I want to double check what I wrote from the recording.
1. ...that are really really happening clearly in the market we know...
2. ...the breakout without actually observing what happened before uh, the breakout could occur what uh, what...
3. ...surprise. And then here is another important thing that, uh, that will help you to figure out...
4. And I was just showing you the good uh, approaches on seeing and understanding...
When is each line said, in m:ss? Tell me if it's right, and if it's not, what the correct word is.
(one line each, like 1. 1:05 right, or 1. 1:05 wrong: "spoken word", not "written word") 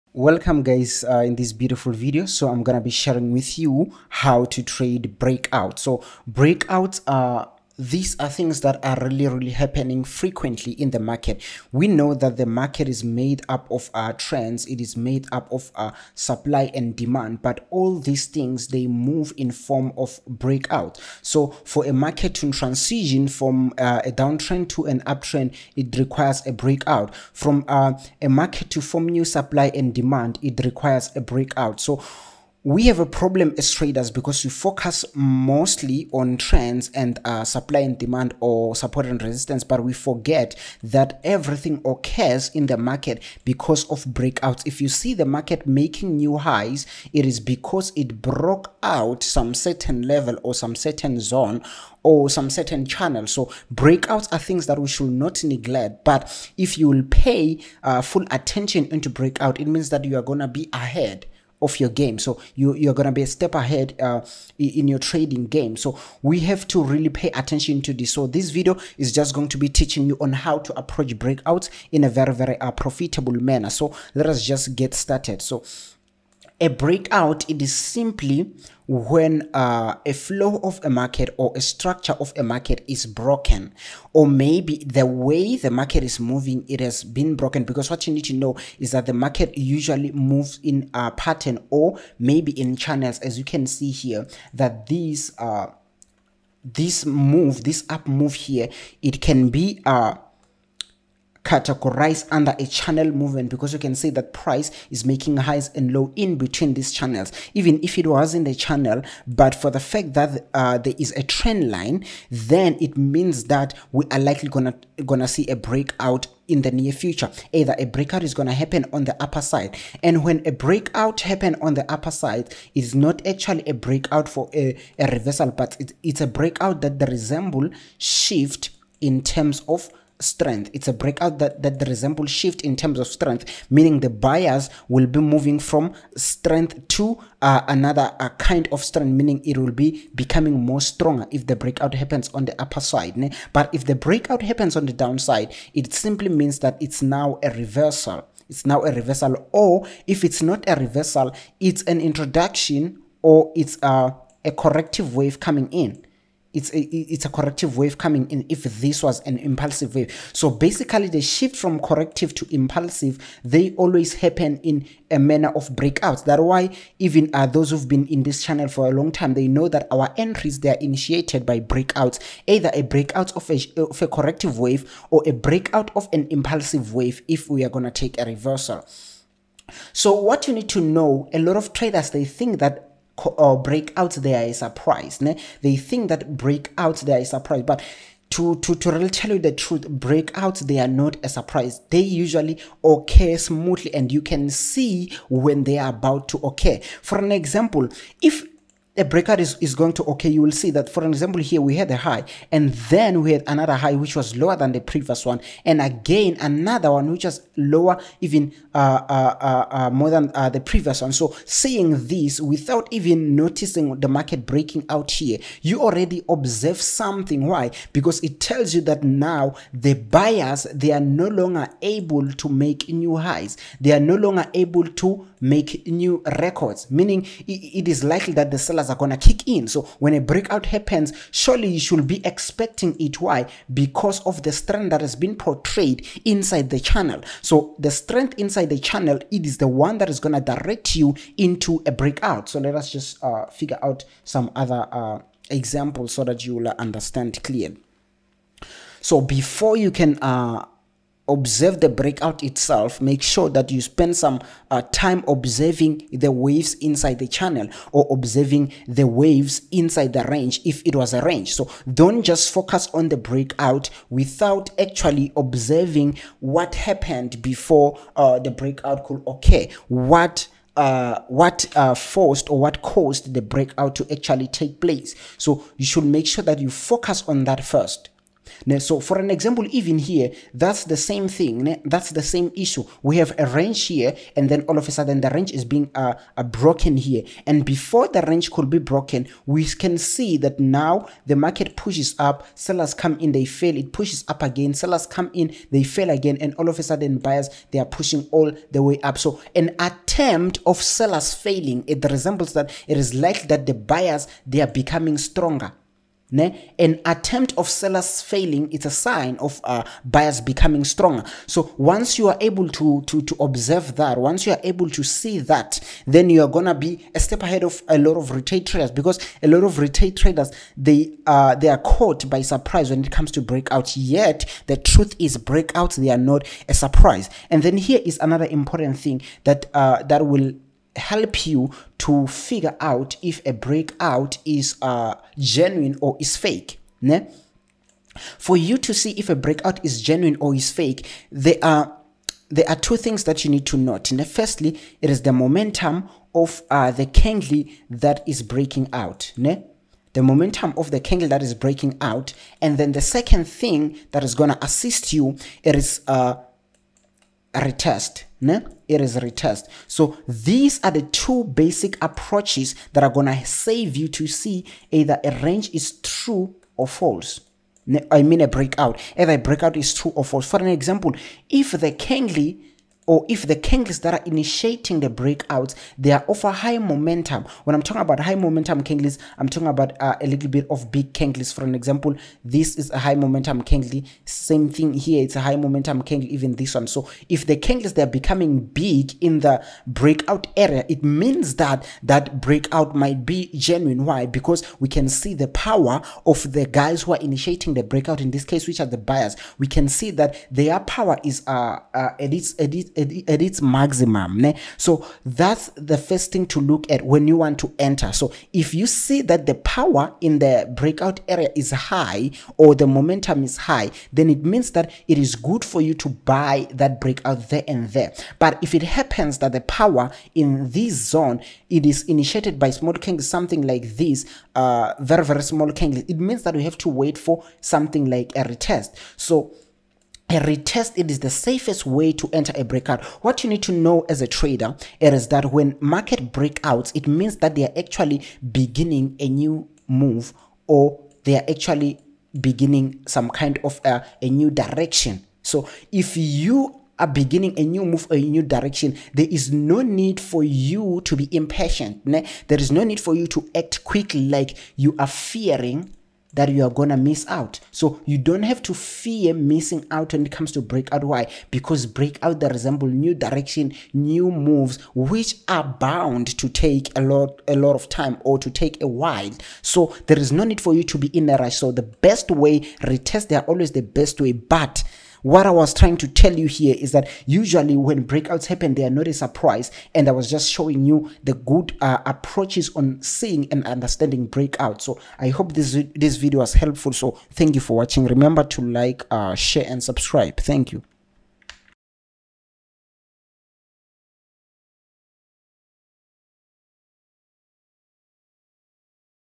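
1. 0:08 wrong: "frequently", not "clearly"
2. 4:23 right
3. 5:26 right
4. 7:59 right.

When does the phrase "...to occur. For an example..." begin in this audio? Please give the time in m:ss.
3:16.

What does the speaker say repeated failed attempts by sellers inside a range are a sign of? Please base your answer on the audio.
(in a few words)
Buyers becoming stronger.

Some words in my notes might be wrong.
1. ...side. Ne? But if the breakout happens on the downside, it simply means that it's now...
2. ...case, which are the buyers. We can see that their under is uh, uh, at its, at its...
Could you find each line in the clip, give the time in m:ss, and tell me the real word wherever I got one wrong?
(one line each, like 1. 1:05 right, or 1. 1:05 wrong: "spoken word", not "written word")
1. 2:22 right
2. 6:38 wrong: "power", not "under".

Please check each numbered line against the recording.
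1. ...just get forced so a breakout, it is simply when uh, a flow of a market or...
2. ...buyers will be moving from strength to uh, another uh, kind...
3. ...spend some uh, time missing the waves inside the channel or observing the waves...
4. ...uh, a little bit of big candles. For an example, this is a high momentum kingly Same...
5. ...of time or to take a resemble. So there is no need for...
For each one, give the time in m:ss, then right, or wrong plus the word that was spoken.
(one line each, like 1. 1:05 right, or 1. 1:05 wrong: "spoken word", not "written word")
1. 1:14 wrong: "started", not "forced"
2. 2:14 right
3. 4:13 wrong: "observing", not "missing"
4. 6:20 right
5. 7:47 wrong: "while", not "resemble".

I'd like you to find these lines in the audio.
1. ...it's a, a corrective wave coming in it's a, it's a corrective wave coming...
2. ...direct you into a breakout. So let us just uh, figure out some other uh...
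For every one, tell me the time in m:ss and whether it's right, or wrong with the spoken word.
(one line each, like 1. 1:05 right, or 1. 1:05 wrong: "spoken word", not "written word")
1. 2:33 right
2. 4:00 right.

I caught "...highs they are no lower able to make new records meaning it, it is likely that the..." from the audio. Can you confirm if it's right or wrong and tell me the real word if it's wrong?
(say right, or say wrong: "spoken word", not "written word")
wrong: "longer", not "lower".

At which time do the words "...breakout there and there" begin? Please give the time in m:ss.
6:57.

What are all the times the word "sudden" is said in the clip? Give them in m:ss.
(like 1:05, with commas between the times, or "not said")
4:44, 4:56.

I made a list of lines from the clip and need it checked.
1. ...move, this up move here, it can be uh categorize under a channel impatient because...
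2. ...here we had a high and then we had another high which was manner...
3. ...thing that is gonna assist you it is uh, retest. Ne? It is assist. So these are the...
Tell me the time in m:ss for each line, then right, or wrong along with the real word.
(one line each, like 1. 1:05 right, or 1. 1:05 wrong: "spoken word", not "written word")
1. 1:37 wrong: "movement", not "impatient"
2. 3:21 wrong: "lower", not "manner"
3. 5:53 wrong: "retest", not "assist".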